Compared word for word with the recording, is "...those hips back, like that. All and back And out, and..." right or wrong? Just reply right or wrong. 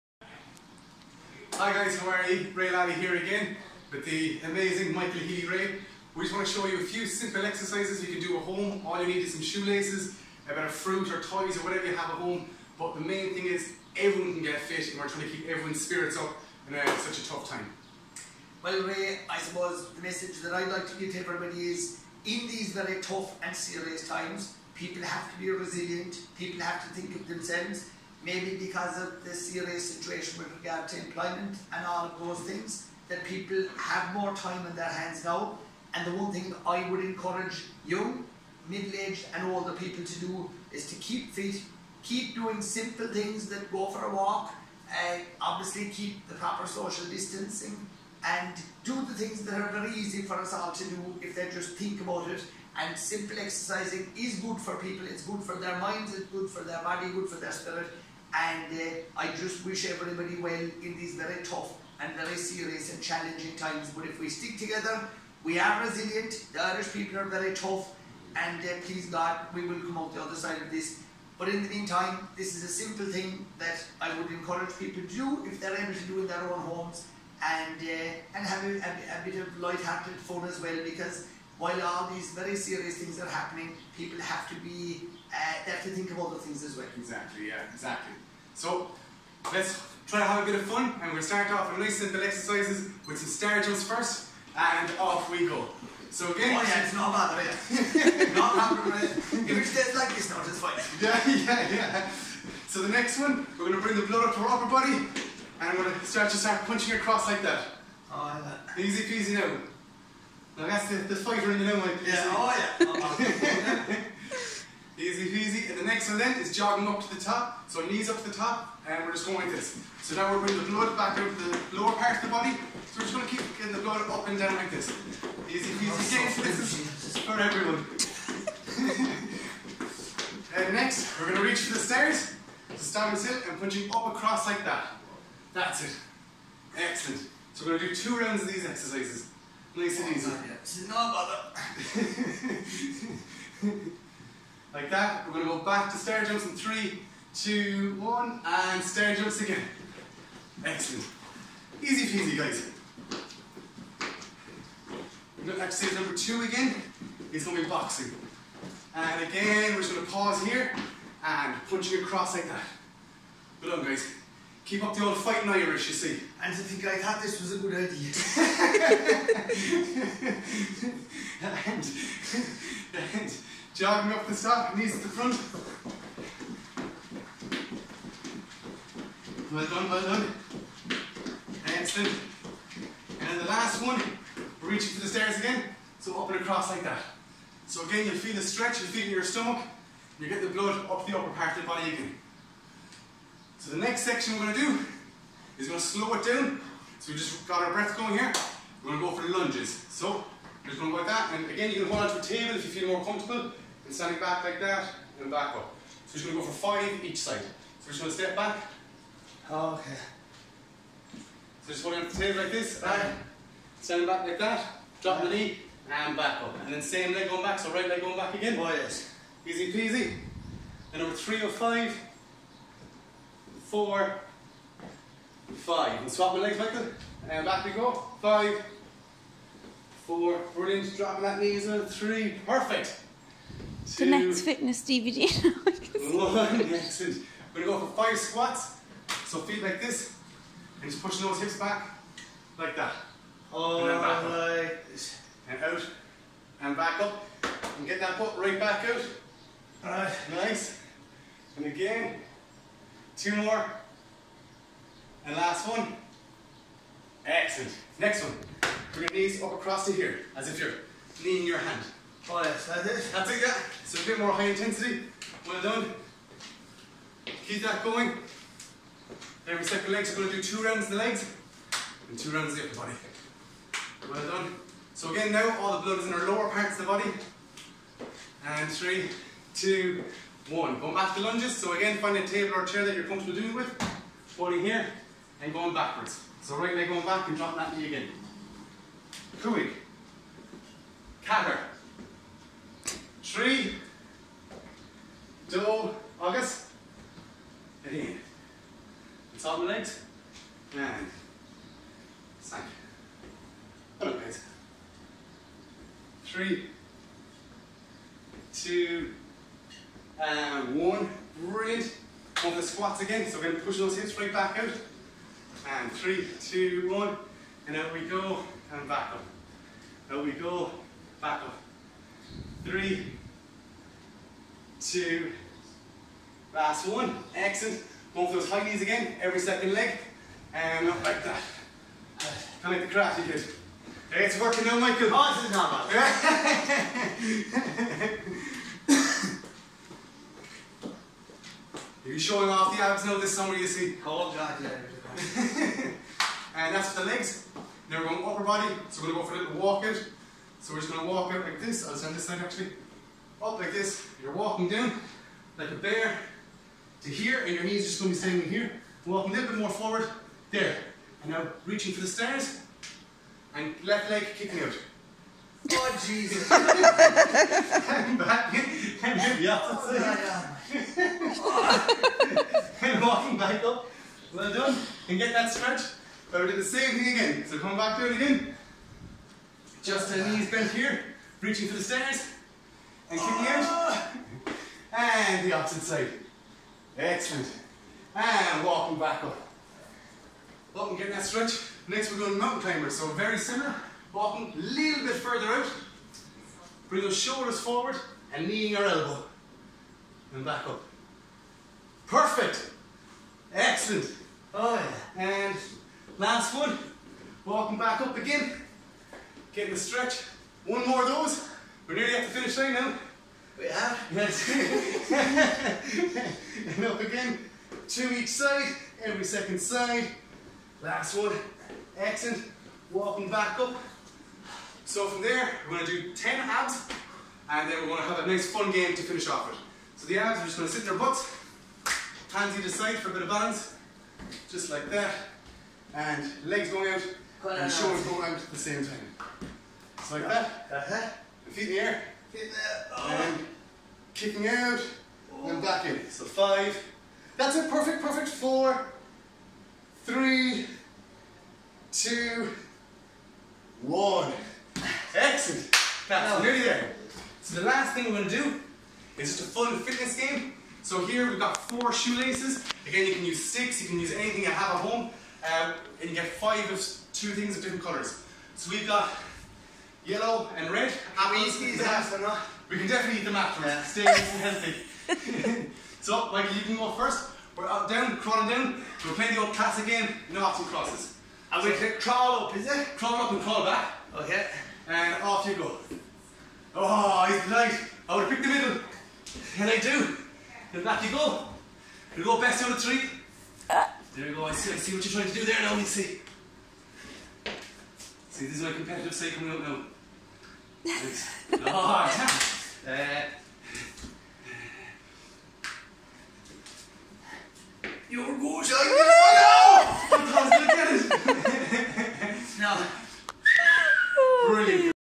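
right.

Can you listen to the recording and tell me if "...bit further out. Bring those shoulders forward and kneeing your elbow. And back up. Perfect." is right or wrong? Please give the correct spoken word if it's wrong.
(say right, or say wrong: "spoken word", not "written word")
right.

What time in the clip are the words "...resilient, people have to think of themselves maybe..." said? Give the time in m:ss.
0:25.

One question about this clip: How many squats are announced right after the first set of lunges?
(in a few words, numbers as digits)
5.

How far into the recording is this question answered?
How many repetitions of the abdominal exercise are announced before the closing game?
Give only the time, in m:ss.
7:06.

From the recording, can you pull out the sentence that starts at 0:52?
And simple exercising is good for people, it's good for their minds, it's good for their body, good for their spirit.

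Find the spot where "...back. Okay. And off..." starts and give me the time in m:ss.
8:03.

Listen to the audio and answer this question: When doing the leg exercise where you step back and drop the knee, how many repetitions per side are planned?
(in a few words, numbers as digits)
5.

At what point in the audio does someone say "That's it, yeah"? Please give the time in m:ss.
4:23.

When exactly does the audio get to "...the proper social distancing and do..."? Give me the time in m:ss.
0:46.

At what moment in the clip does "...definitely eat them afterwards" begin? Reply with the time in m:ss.
7:52.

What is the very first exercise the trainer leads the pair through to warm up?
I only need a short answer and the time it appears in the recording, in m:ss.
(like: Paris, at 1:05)
star jumps, at 1:33.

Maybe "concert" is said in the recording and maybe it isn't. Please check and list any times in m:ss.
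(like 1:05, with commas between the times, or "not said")
not said.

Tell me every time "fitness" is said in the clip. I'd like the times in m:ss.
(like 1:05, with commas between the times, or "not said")
3:54, 7:39.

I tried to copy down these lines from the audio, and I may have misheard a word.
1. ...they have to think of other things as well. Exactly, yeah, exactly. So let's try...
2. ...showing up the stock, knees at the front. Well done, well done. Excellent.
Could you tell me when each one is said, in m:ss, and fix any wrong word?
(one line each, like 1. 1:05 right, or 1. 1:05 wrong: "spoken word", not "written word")
1. 1:25 right
2. 2:53 wrong: "jogging", not "showing".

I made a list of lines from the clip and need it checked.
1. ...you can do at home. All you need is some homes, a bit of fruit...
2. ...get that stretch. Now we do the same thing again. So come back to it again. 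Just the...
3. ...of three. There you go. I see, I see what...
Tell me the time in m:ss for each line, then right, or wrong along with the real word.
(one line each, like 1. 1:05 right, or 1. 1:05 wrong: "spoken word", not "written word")
1. 0:08 wrong: "shoelaces", not "homes"
2. 6:15 right
3. 8:12 right.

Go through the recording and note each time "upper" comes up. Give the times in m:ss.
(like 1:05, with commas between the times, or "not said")
1:44, 3:11, 4:32, 5:48.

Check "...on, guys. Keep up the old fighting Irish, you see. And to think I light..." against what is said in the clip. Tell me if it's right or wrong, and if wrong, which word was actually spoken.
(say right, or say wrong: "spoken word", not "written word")
wrong: "thought", not "light".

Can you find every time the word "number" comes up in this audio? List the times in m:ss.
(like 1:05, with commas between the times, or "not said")
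2:35, 3:41.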